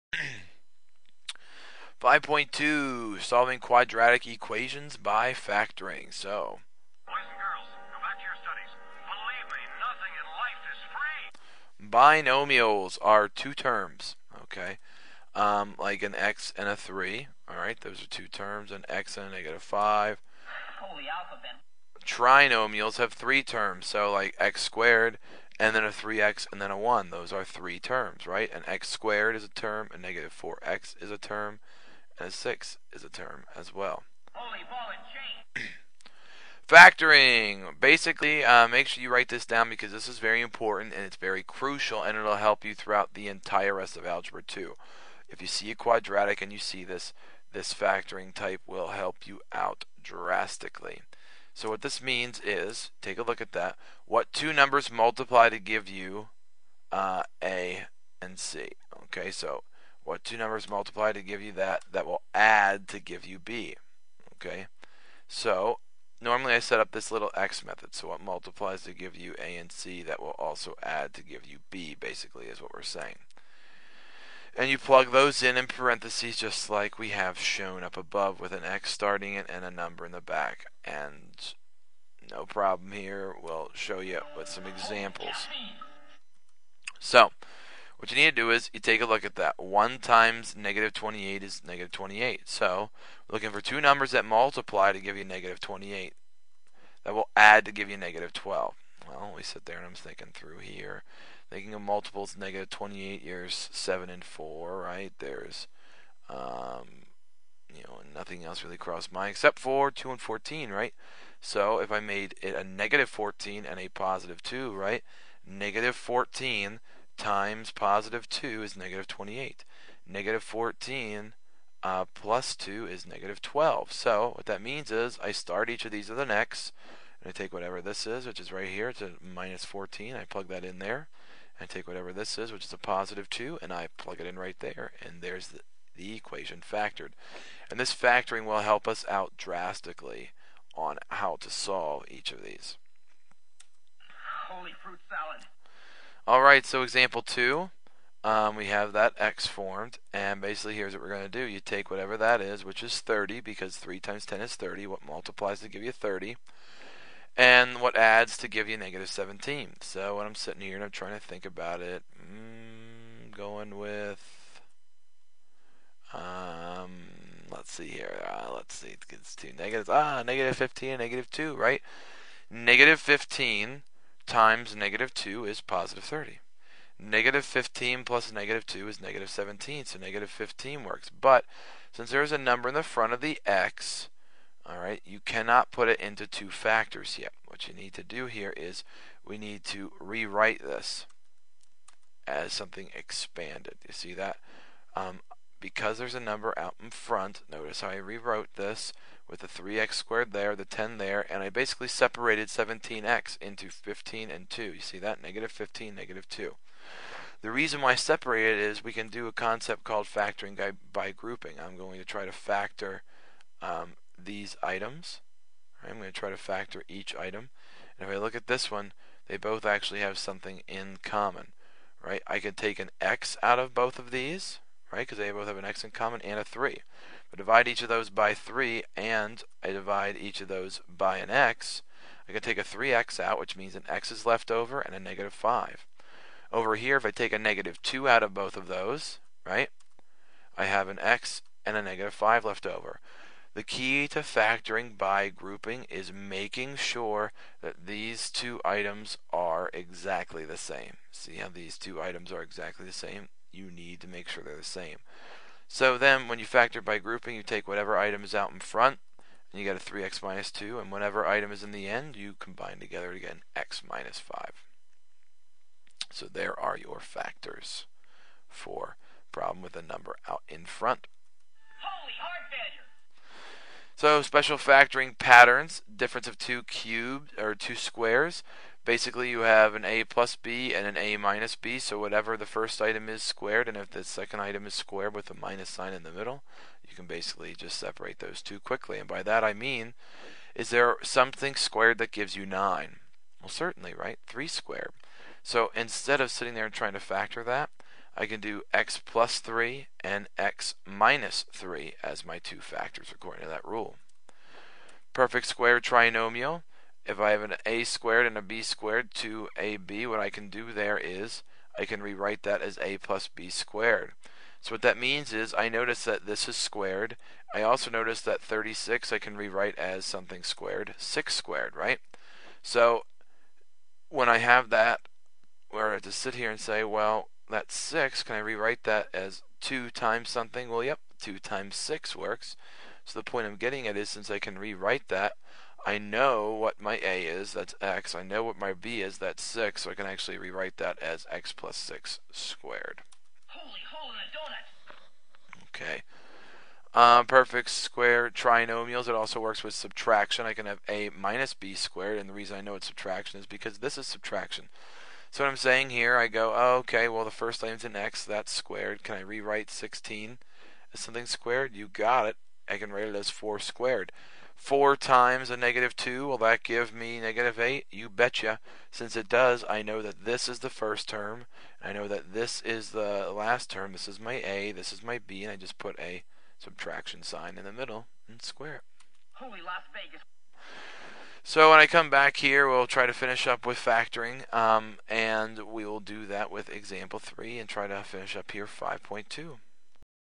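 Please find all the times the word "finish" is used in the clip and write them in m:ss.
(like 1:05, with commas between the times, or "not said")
6:23, 6:28.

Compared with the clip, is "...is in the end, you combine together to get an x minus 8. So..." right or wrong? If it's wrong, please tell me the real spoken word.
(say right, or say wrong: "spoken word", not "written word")
wrong: "5", not "8".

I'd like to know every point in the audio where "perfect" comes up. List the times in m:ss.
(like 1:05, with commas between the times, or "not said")
5:05, 5:47.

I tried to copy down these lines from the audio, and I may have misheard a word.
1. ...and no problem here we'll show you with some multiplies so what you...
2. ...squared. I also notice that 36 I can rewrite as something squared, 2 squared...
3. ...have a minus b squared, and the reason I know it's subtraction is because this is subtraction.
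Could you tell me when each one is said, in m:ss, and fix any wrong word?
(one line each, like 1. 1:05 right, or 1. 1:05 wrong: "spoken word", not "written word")
1. 1:20 wrong: "examples", not "multiplies"
2. 5:16 wrong: "6", not "2"
3. 5:50 right.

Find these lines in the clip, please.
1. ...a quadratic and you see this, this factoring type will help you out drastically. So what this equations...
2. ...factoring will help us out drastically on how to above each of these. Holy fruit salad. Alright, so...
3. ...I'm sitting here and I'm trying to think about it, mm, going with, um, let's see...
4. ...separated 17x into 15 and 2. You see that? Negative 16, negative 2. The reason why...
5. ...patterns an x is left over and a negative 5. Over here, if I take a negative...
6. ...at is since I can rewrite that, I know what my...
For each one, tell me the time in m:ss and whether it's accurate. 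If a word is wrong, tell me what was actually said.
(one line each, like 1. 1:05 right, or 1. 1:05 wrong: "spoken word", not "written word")
1. 0:45 wrong: "means", not "equations"
2. 2:17 wrong: "solve", not "above"
3. 2:40 right
4. 3:21 wrong: "15", not "16"
5. 3:53 wrong: "means", not "patterns"
6. 5:33 right.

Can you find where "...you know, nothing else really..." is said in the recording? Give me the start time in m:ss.
1:47.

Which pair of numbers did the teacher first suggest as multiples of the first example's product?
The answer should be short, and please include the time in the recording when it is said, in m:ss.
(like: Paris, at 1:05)
7 and 4, at 1:43.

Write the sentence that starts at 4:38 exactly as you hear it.
Basically, you have an a plus b and an a minus b.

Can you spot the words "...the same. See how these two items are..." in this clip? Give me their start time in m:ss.
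4:10.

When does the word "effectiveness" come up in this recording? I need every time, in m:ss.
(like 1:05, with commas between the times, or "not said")
not said.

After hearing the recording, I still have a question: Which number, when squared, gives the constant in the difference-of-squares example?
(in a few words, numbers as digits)
3.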